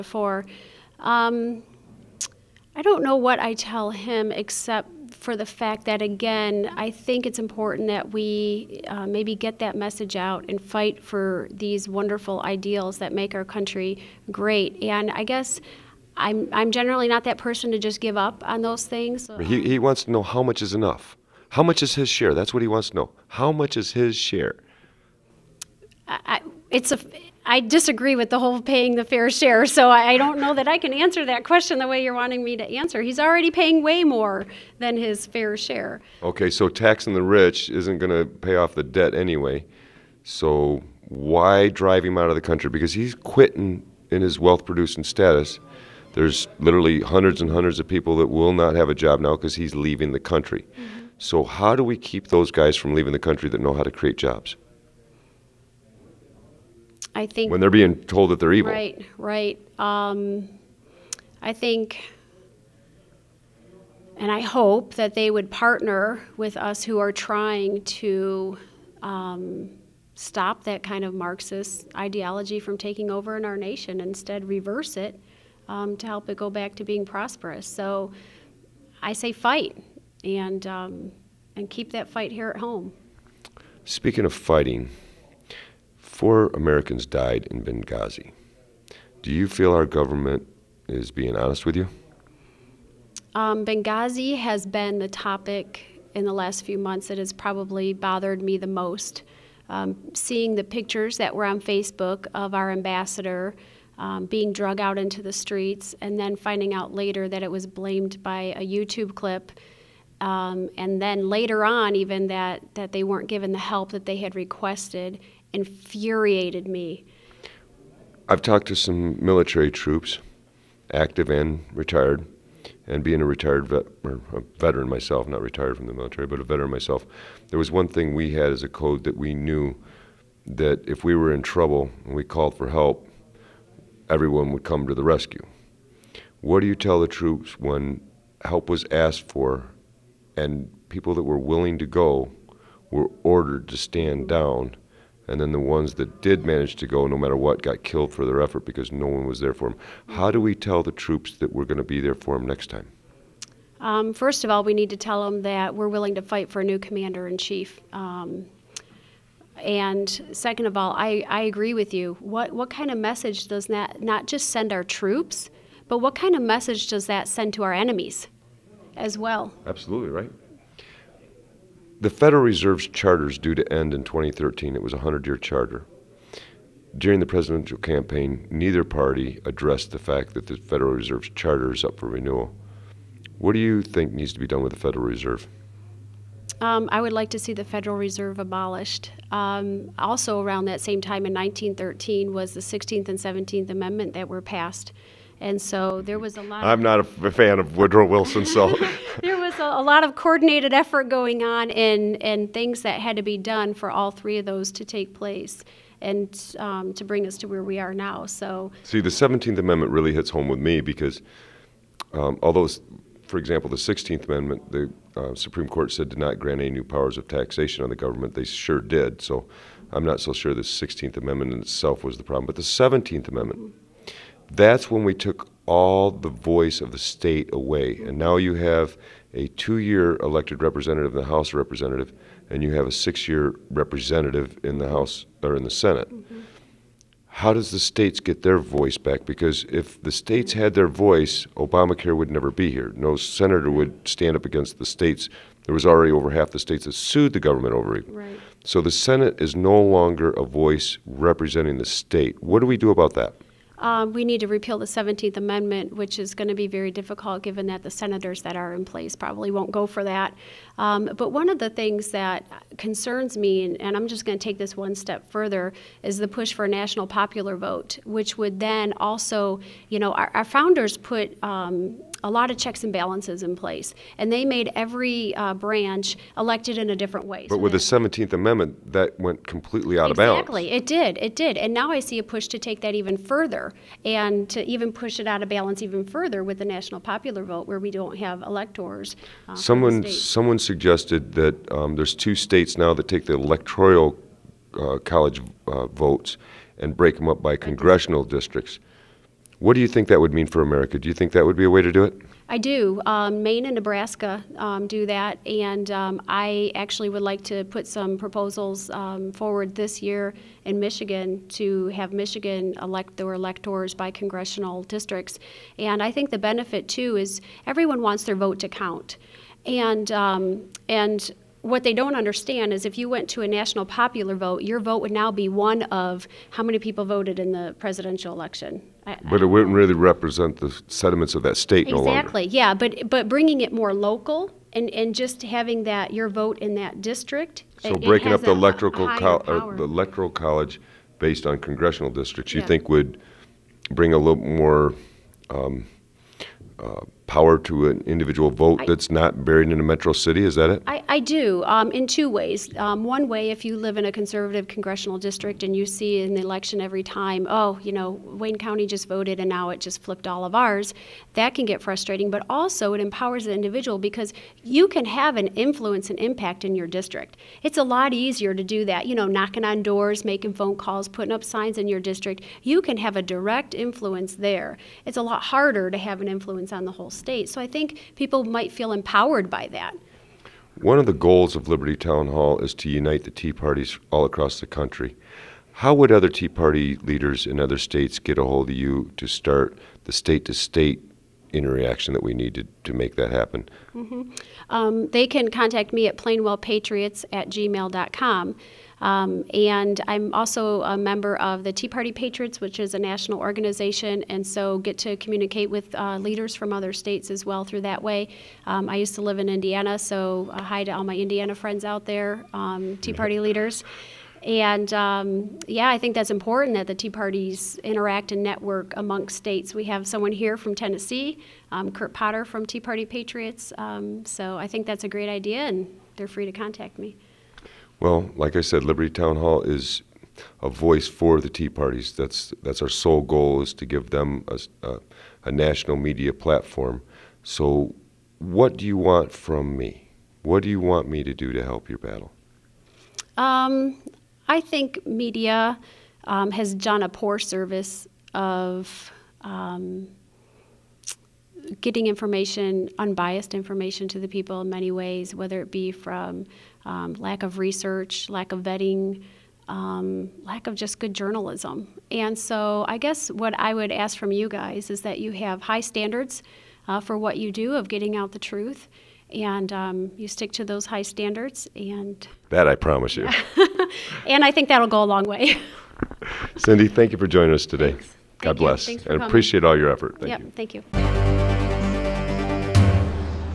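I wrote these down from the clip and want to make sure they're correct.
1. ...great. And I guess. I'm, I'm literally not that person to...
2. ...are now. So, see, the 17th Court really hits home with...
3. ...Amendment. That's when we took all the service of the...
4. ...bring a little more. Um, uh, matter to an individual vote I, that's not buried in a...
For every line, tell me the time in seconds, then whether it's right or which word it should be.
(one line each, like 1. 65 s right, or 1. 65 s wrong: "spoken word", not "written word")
1. 14 s wrong: "generally", not "literally"
2. 207 s wrong: "Amendment", not "Court"
3. 223 s wrong: "voice", not "service"
4. 343 s wrong: "power", not "matter".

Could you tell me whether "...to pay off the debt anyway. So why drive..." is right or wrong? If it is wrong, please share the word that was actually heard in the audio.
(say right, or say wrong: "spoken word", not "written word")
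right.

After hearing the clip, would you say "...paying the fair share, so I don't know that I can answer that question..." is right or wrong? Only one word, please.
right.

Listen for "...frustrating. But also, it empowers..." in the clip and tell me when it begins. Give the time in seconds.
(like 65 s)
361 s.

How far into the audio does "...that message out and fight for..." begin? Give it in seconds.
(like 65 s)
9 s.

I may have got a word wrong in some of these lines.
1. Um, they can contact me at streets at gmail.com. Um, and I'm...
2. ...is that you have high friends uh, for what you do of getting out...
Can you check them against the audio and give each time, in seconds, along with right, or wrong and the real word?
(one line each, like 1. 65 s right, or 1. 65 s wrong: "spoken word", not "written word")
1. 394 s wrong: "plainwellpatriots", not "streets"
2. 464 s wrong: "standards", not "friends".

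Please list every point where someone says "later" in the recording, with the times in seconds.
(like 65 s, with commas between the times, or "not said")
106 s, 111 s.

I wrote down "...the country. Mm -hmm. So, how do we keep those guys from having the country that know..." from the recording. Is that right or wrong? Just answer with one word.
wrong.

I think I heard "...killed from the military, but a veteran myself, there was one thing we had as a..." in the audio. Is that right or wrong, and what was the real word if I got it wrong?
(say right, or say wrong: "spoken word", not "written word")
wrong: "retired", not "killed".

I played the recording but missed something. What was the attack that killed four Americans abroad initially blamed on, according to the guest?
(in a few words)
YouTube clip.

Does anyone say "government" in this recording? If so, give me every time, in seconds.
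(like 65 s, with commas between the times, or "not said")
89 s, 217 s, 247 s.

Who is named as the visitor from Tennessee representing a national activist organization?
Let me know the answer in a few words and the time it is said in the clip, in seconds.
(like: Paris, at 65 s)
Kurt Potter, at 421 s.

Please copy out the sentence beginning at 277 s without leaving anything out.
But so with the 17th Amendment, that went completely out exactly.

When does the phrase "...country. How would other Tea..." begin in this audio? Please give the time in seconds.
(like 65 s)
384 s.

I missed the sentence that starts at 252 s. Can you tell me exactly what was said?
What do we do about that?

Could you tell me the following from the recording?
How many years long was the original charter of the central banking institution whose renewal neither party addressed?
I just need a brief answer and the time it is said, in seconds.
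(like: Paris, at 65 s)
100, at 174 s.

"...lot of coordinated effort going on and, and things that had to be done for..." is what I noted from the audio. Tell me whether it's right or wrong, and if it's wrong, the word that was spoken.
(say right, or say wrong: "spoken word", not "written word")
right.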